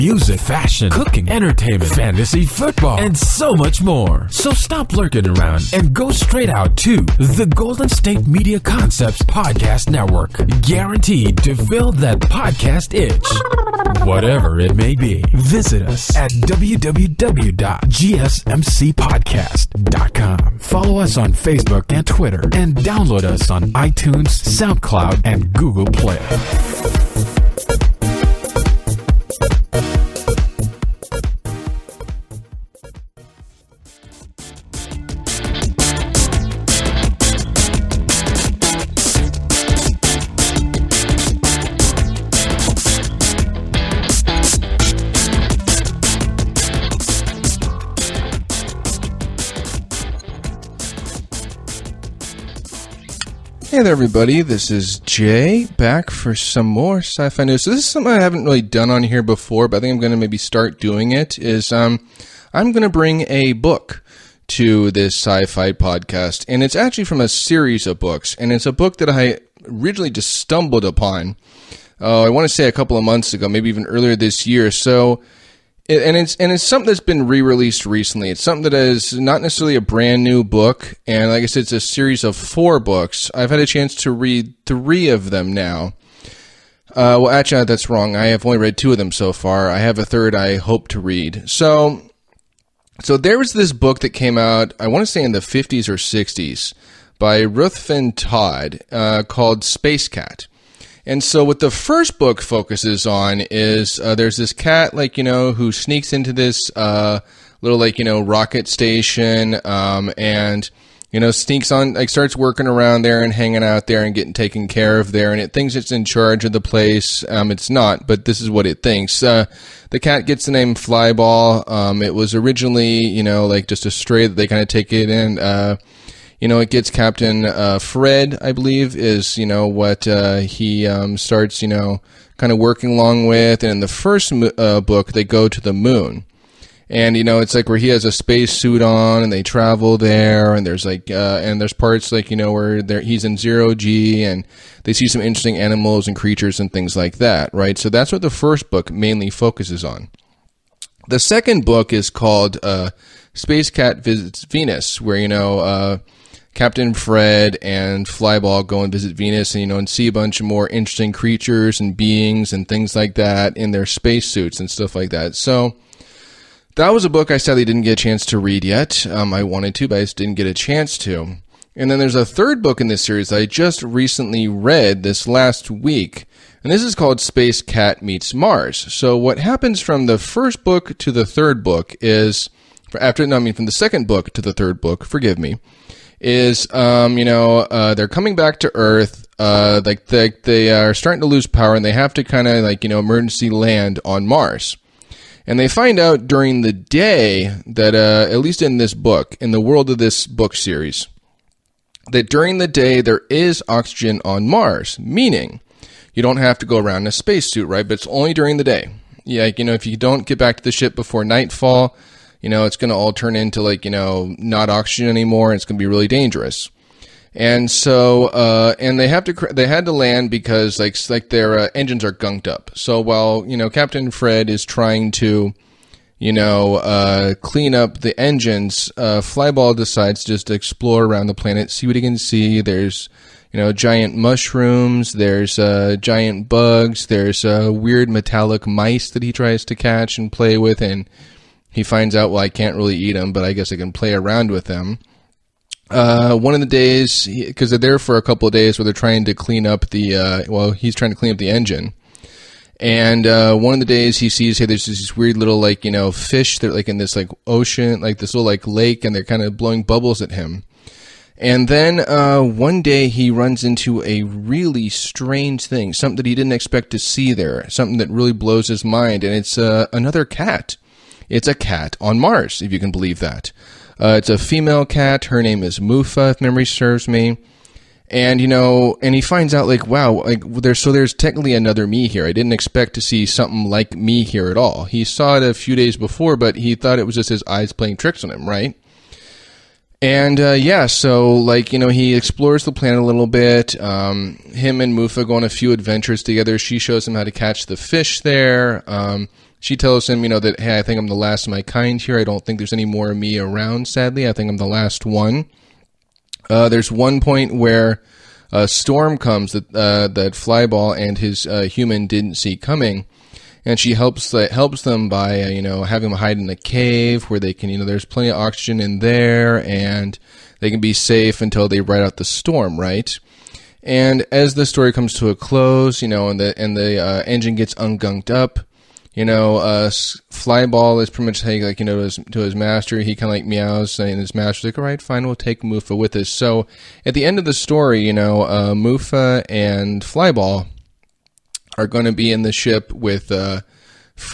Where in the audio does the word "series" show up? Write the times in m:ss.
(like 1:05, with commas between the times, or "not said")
1:07, 1:21, 2:53, 3:20.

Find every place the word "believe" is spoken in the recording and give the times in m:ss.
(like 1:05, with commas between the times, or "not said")
2:08, 4:32.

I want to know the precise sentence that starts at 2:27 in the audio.
So that's what the first book mainly focuses on.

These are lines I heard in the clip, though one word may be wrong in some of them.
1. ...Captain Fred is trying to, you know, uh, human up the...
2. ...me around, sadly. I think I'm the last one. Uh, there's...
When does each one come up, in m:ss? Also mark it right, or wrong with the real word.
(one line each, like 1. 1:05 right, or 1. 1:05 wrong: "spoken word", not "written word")
1. 3:43 wrong: "clean", not "human"
2. 5:03 right.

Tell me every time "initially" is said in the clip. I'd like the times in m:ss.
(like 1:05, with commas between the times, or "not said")
not said.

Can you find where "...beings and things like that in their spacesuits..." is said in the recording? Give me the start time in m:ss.
2:41.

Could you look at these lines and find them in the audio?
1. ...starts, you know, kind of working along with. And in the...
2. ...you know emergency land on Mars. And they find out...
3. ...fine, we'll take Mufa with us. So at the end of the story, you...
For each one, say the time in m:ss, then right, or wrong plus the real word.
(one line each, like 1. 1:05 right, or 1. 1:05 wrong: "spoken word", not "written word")
1. 2:11 right
2. 3:12 right
3. 5:35 right.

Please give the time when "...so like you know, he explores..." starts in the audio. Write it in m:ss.
4:50.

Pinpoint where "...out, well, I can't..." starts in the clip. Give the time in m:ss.
4:02.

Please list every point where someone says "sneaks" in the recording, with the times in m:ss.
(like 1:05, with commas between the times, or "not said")
1:45, 1:51.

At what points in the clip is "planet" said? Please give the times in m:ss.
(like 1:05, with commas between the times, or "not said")
3:51, 4:52.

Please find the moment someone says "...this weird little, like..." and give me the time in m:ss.
4:14.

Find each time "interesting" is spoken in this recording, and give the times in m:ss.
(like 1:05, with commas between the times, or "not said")
2:25, 2:40.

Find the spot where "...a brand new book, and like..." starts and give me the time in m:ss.
1:19.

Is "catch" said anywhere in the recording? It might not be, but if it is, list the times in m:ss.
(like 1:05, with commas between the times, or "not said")
3:59, 4:57.